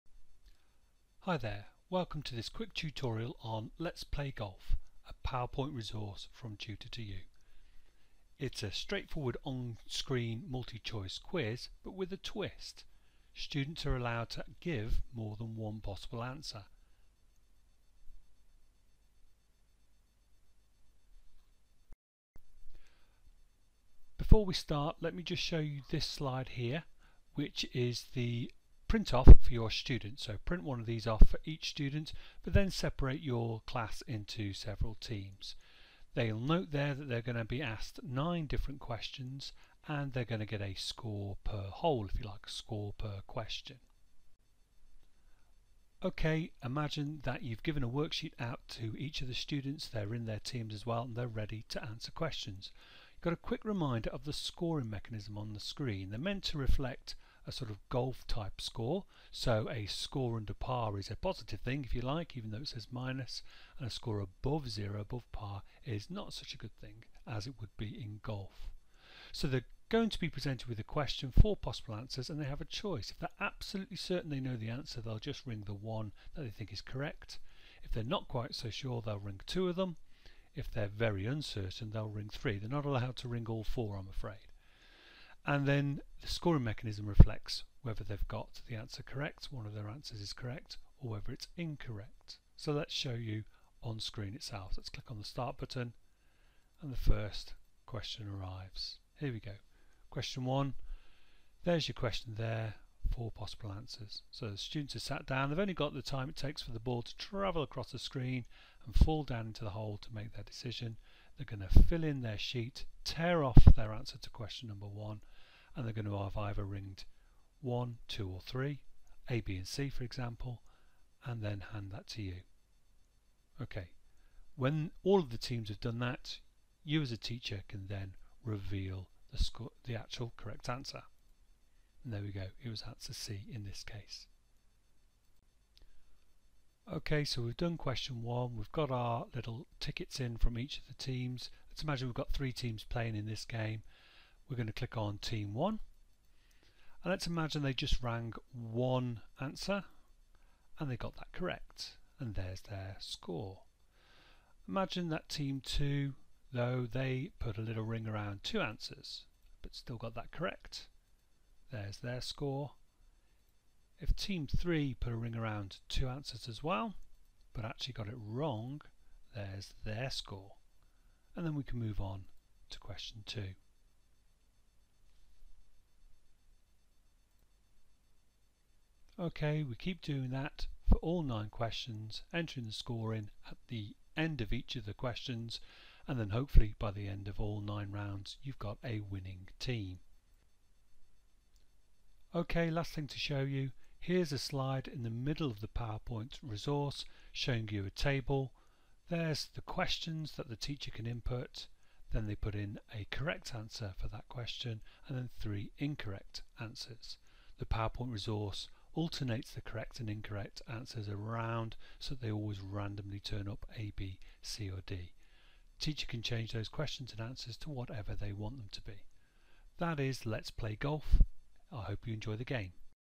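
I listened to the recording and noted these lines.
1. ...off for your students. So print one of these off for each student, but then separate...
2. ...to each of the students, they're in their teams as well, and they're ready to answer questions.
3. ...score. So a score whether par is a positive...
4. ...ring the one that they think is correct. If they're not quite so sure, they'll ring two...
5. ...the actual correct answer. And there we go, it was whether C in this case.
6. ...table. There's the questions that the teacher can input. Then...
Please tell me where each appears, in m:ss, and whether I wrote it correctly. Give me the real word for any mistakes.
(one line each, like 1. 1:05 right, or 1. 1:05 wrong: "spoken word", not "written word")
1. 0:29 right
2. 0:48 right
3. 0:58 wrong: "under", not "whether"
4. 1:15 right
5. 2:09 wrong: "answer", not "whether"
6. 3:17 right.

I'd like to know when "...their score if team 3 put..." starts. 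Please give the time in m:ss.
2:41.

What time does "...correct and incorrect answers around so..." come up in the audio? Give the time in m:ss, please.
3:29.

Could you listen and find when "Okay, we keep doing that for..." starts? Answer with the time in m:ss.
2:59.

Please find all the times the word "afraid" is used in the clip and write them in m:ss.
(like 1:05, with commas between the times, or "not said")
1:24.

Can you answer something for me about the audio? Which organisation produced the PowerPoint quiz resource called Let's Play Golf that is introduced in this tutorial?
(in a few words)
tutor2u.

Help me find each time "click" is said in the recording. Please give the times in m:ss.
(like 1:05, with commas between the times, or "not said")
1:34, 2:24.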